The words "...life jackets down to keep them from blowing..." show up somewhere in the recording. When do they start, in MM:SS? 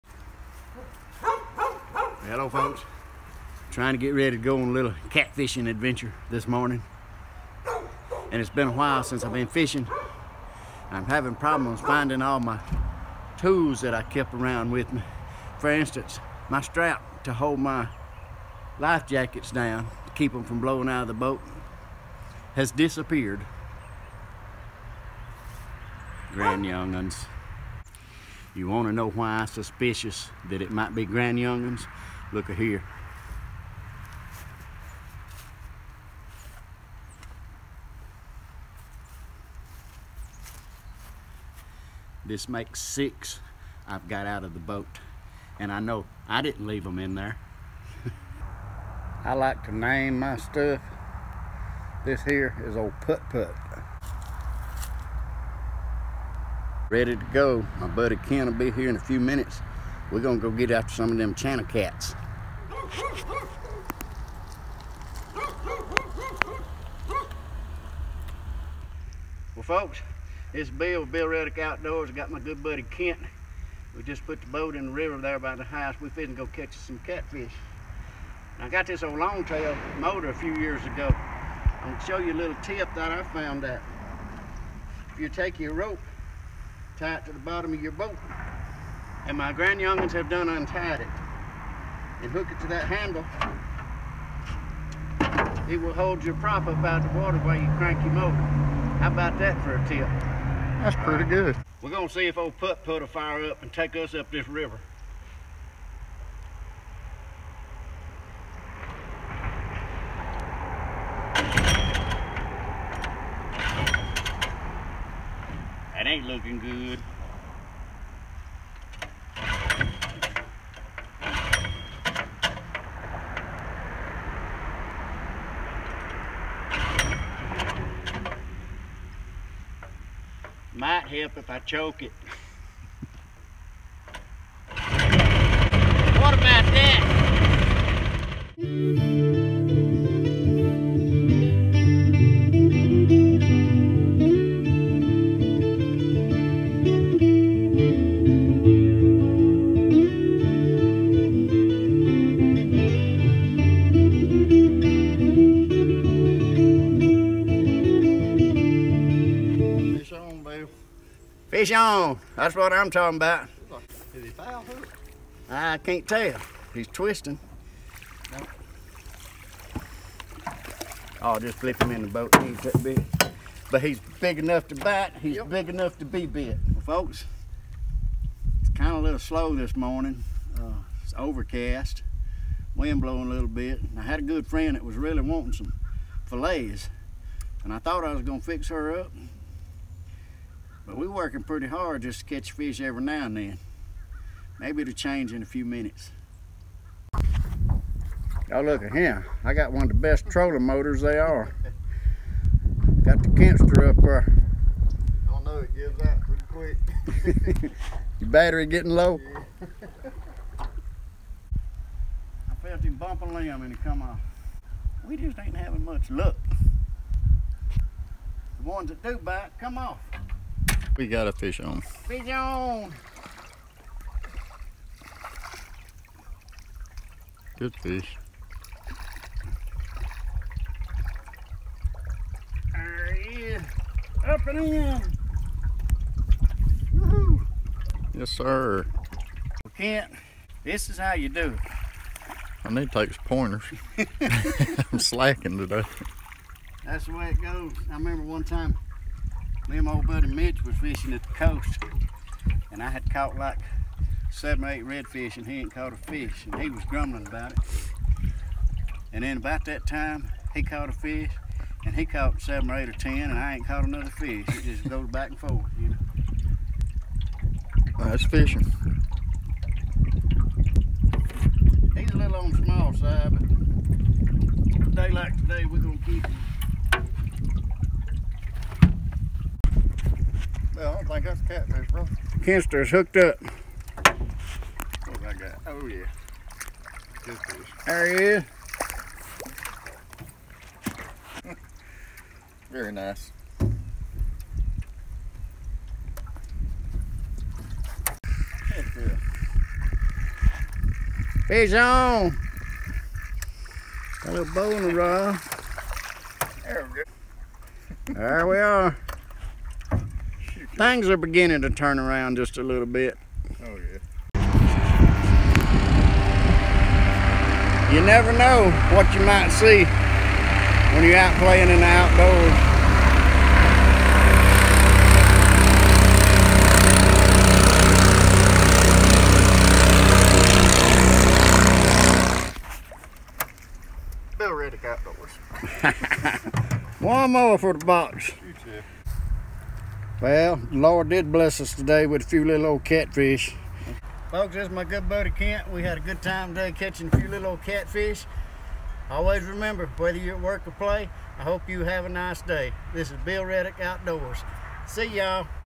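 00:18.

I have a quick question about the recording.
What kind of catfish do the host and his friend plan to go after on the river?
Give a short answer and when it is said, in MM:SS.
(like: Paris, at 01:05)
channel cats, at 01:01.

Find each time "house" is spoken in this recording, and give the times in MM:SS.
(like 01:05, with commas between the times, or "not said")
01:15.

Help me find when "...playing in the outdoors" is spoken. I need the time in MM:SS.
05:21.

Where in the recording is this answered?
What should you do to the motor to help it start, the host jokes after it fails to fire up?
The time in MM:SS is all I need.
02:11.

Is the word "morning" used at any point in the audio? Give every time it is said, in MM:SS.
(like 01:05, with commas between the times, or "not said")
00:06, 02:59.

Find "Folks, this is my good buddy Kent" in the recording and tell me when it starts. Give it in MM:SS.
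05:44.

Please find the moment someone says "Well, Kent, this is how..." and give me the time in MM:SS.
03:59.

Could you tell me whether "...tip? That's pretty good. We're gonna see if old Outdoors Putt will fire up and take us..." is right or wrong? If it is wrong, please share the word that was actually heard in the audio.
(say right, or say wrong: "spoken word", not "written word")
wrong: "Putt", not "Outdoors".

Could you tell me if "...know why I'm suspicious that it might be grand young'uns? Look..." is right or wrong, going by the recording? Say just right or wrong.
right.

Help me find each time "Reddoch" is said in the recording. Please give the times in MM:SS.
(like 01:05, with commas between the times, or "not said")
01:11, 05:34, 05:53.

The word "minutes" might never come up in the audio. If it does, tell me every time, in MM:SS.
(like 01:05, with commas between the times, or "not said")
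00:59, 03:15.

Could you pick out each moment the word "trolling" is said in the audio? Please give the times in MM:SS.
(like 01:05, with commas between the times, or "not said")
03:20.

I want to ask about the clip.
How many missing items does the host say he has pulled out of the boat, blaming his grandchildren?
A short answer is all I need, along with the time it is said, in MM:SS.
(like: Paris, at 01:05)
6, at 00:42.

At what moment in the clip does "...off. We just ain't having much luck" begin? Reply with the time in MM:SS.
03:34.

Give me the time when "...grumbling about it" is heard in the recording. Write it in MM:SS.
04:16.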